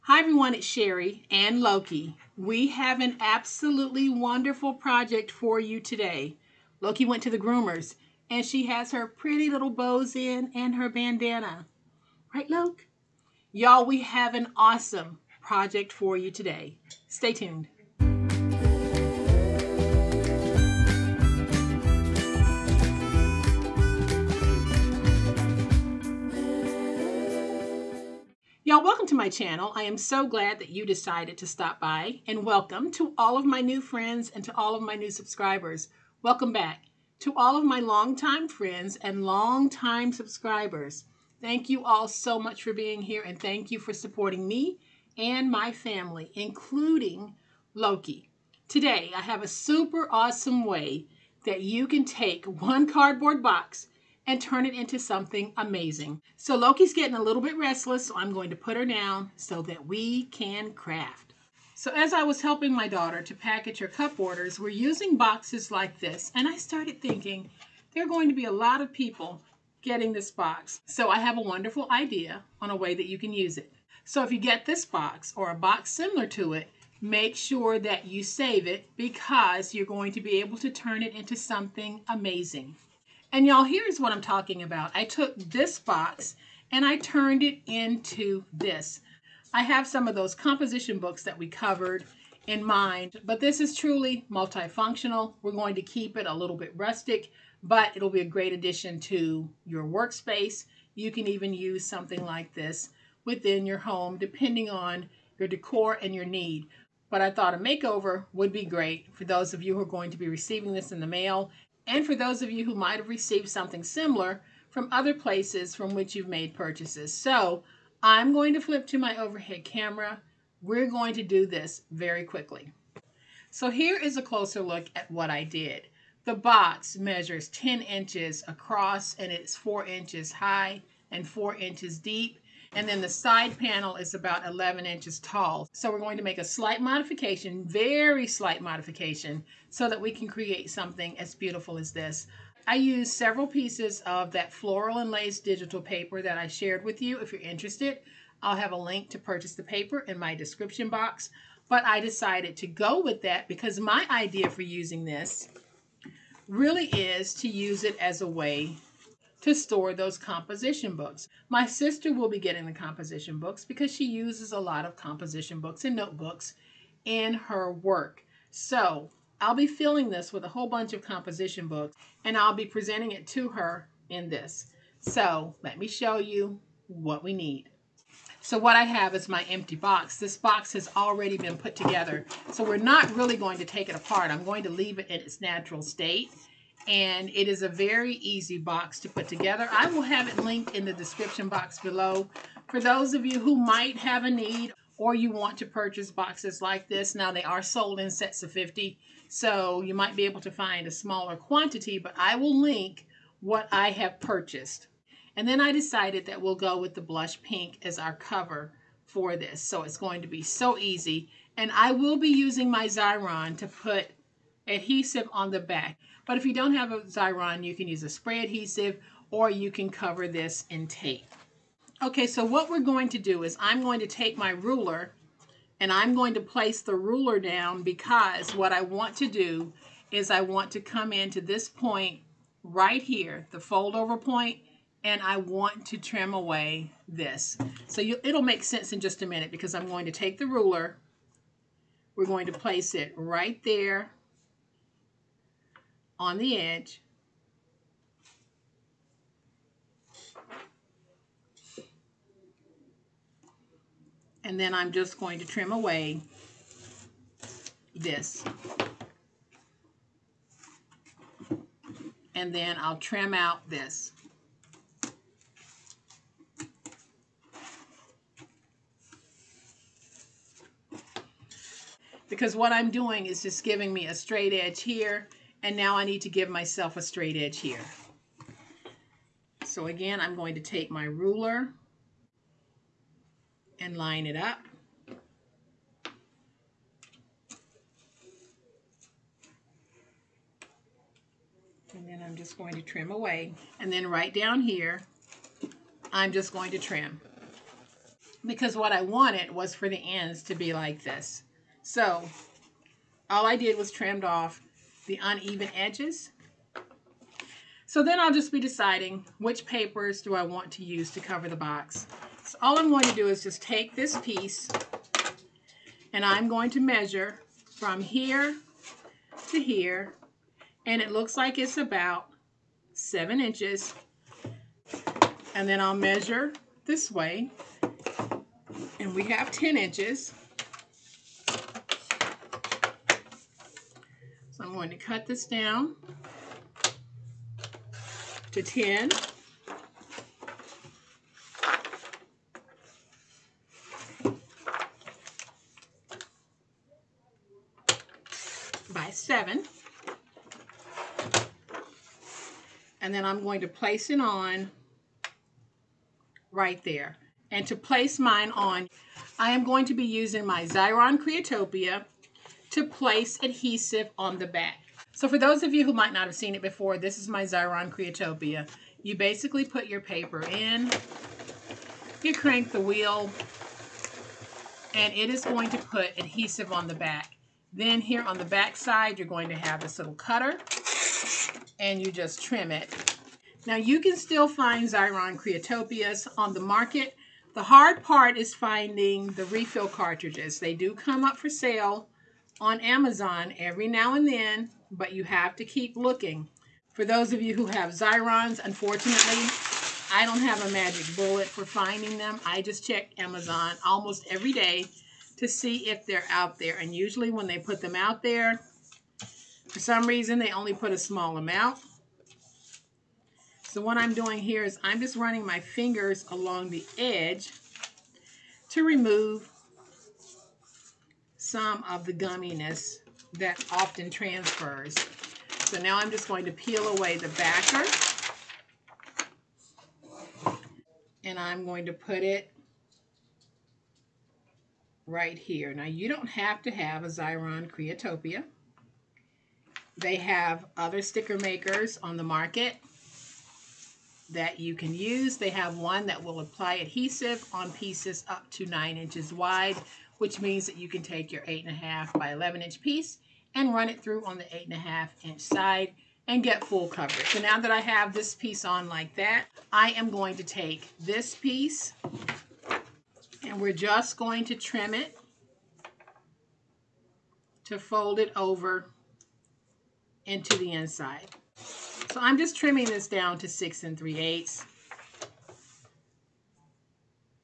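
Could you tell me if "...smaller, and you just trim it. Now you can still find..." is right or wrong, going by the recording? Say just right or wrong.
wrong.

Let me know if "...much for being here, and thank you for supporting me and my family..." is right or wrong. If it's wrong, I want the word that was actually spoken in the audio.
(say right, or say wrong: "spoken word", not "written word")
right.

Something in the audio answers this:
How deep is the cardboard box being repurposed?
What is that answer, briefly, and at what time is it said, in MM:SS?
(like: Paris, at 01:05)
4 inches, at 02:11.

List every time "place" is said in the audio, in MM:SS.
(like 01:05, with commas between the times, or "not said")
01:55, 03:46, 04:02, 05:53, 05:57, 06:02.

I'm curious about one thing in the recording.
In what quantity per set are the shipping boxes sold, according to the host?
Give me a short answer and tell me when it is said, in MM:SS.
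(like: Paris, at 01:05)
50, at 03:18.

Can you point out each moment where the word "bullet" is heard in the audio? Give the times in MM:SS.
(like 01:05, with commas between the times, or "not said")
06:41.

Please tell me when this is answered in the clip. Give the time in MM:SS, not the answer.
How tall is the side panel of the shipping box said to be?
02:14.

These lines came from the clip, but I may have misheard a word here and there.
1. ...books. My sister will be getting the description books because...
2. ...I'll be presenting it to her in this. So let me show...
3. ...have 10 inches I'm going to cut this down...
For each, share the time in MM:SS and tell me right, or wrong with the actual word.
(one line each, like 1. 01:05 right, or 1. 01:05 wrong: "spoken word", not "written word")
1. 02:40 wrong: "composition", not "description"
2. 02:52 right
3. 05:29 right.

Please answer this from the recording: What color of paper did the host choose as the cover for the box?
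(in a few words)
blush pink.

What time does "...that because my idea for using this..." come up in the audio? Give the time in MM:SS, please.
02:33.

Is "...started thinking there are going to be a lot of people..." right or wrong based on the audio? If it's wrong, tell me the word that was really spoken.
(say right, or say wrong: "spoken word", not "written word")
right.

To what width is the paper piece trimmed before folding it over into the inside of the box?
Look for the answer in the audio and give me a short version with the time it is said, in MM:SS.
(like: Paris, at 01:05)
6 3/8 inches, at 07:53.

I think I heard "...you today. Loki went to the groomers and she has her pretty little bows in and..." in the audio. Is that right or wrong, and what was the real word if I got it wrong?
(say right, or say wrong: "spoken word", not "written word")
right.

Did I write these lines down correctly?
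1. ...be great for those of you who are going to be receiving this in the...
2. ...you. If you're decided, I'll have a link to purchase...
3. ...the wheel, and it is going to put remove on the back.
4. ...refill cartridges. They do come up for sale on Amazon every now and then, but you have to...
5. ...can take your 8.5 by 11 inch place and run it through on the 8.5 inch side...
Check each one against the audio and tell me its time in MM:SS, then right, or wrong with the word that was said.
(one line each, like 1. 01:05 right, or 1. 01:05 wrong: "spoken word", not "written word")
1. 01:48 right
2. 02:27 wrong: "interested", not "decided"
3. 06:12 wrong: "adhesive", not "remove"
4. 06:29 right
5. 07:30 wrong: "piece", not "place".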